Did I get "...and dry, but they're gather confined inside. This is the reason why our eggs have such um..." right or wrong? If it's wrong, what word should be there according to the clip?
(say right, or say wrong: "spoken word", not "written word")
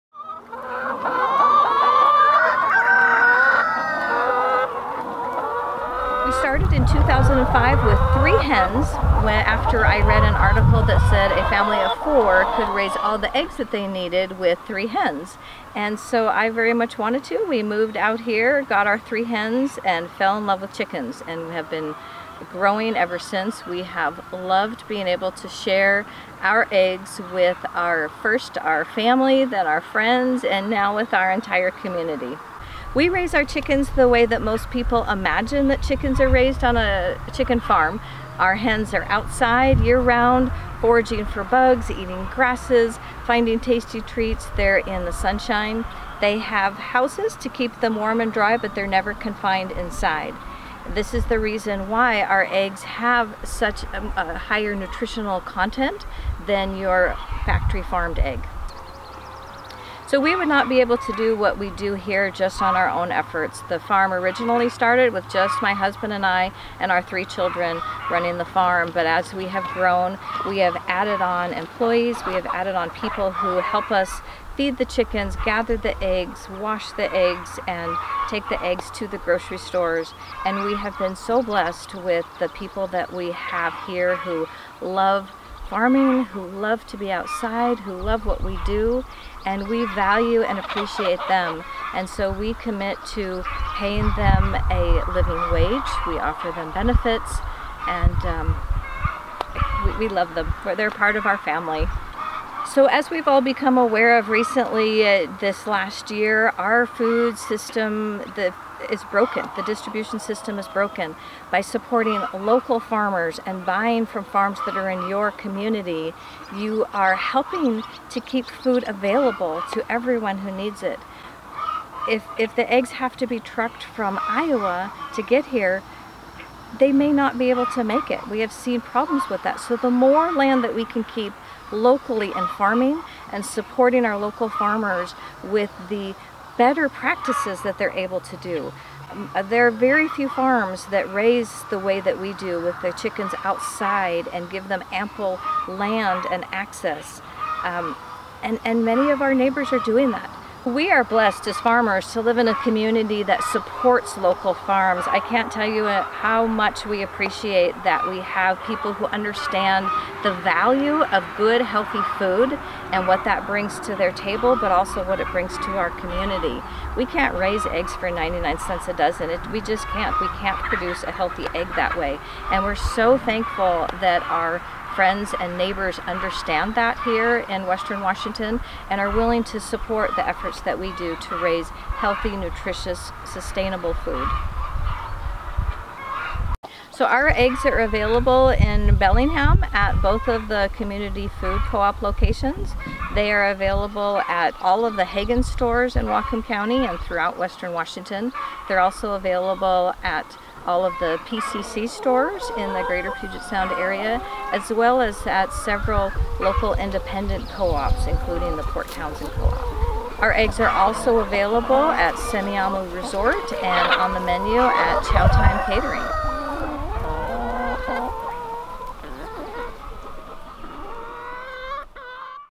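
wrong: "never", not "gather".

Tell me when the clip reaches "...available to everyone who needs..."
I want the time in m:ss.
1:58.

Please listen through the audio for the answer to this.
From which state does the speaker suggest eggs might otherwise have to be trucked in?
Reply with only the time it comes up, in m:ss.
2:04.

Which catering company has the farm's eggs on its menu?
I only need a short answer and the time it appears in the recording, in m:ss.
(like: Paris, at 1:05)
Chow Time Catering, at 3:35.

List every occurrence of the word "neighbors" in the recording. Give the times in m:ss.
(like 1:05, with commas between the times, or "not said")
2:29, 2:55.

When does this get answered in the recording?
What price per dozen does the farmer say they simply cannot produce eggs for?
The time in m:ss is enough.
2:48.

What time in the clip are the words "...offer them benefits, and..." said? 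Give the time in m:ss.
1:36.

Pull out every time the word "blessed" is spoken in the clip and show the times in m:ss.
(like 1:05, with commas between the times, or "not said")
1:21, 2:31.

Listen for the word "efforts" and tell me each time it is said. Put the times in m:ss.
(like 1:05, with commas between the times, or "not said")
1:03, 3:00.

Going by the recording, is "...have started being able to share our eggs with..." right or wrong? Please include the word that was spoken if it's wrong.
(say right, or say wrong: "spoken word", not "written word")
wrong: "loved", not "started".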